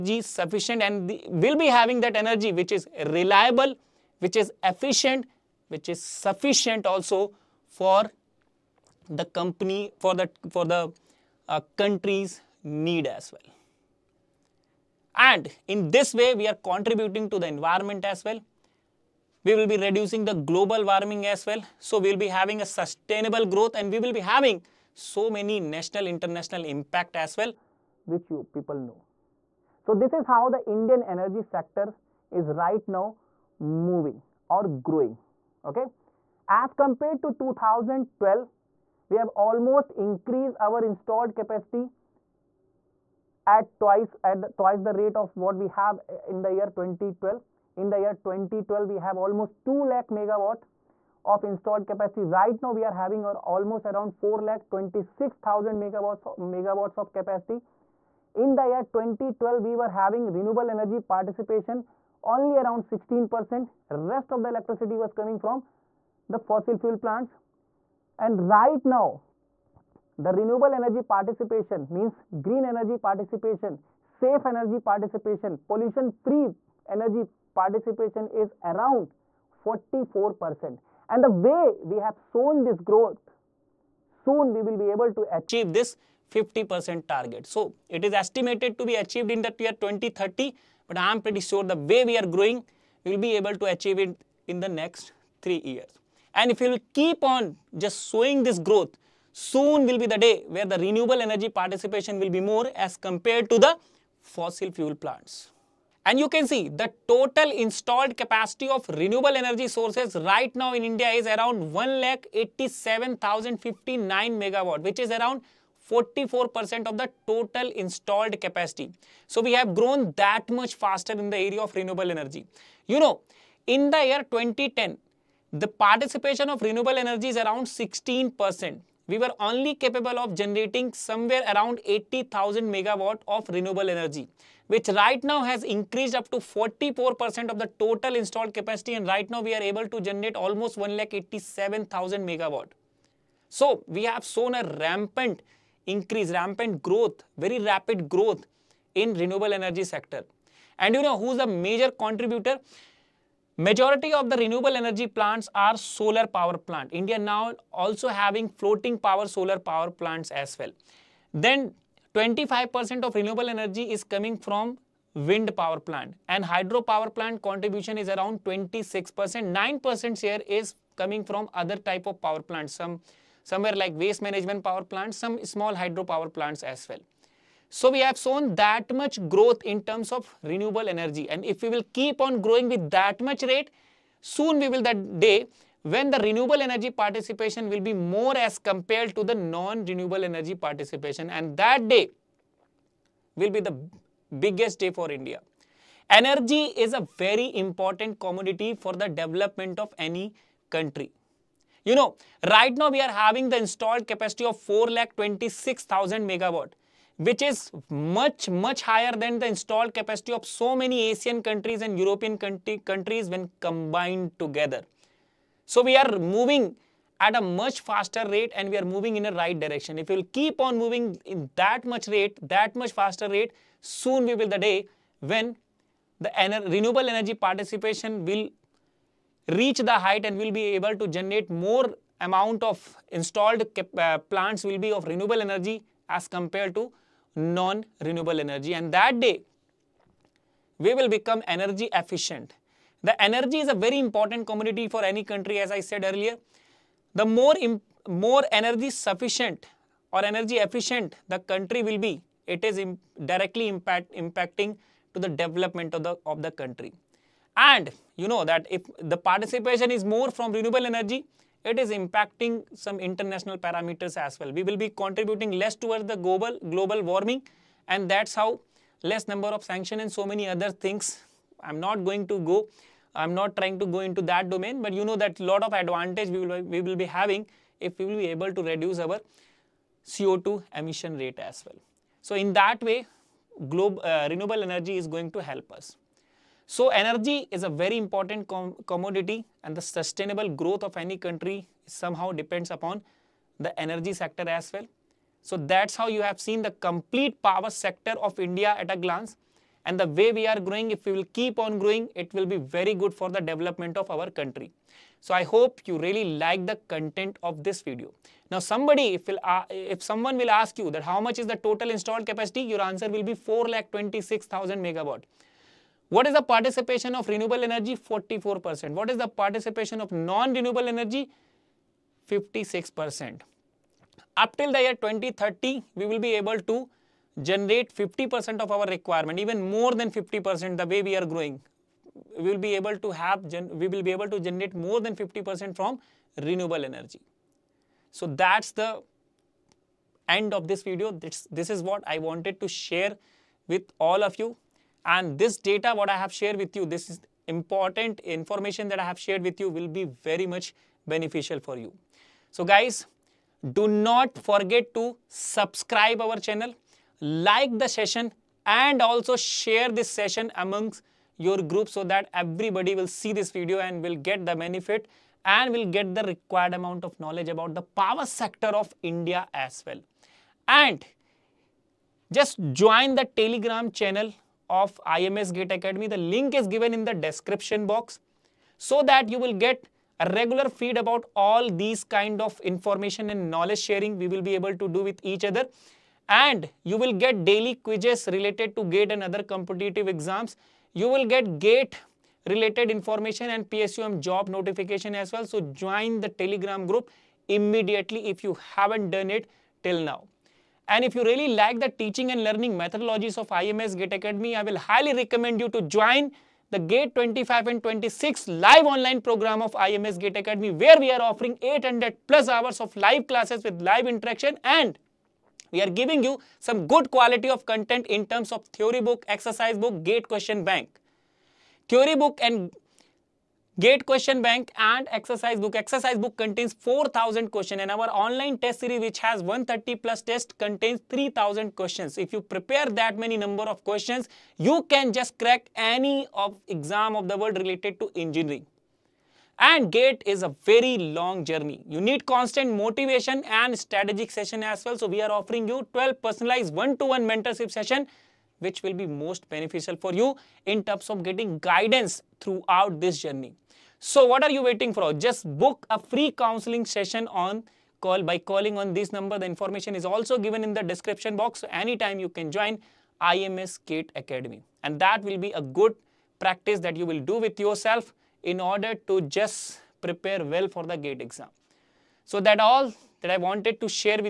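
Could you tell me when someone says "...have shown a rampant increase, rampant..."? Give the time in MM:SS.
02:24.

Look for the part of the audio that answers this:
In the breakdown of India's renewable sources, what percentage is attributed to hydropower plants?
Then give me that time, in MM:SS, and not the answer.
02:48.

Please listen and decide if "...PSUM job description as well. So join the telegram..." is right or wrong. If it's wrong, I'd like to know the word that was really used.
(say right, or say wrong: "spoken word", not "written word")
wrong: "notification", not "description".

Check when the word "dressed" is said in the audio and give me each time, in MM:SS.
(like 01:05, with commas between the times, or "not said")
not said.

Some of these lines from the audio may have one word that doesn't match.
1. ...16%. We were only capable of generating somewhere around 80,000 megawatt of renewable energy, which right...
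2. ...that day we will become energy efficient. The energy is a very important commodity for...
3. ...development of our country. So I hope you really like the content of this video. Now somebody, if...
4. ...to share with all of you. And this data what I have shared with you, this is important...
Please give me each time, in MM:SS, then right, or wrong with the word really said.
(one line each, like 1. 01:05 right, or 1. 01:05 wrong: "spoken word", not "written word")
1. 02:07 right
2. 03:58 right
3. 05:03 right
4. 05:42 right.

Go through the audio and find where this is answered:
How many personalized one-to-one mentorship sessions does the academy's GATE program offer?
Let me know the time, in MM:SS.
07:25.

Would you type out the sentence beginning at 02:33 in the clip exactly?
Majority of the renewable energy plants are solar power plant.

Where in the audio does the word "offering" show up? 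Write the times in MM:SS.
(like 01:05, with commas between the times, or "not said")
06:51, 07:25.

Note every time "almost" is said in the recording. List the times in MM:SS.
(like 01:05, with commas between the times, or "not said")
00:39, 00:49, 00:53, 02:20.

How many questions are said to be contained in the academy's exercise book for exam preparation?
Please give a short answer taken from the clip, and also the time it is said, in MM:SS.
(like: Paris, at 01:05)
4000, at 07:06.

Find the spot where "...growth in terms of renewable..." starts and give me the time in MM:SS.
02:59.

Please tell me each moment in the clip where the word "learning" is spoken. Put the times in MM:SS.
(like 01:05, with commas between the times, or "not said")
06:42.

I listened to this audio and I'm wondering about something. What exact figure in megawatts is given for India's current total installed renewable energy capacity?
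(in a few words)
1,87,059 megawatt.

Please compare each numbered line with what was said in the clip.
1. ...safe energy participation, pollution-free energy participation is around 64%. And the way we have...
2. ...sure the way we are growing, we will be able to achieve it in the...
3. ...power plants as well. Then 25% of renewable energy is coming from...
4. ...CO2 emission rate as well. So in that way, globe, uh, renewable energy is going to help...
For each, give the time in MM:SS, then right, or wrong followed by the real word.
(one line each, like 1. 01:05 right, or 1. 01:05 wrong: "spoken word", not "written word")
1. 01:13 wrong: "44", not "64"
2. 01:31 right
3. 02:39 right
4. 04:40 right.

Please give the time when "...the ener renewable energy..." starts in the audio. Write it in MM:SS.
03:46.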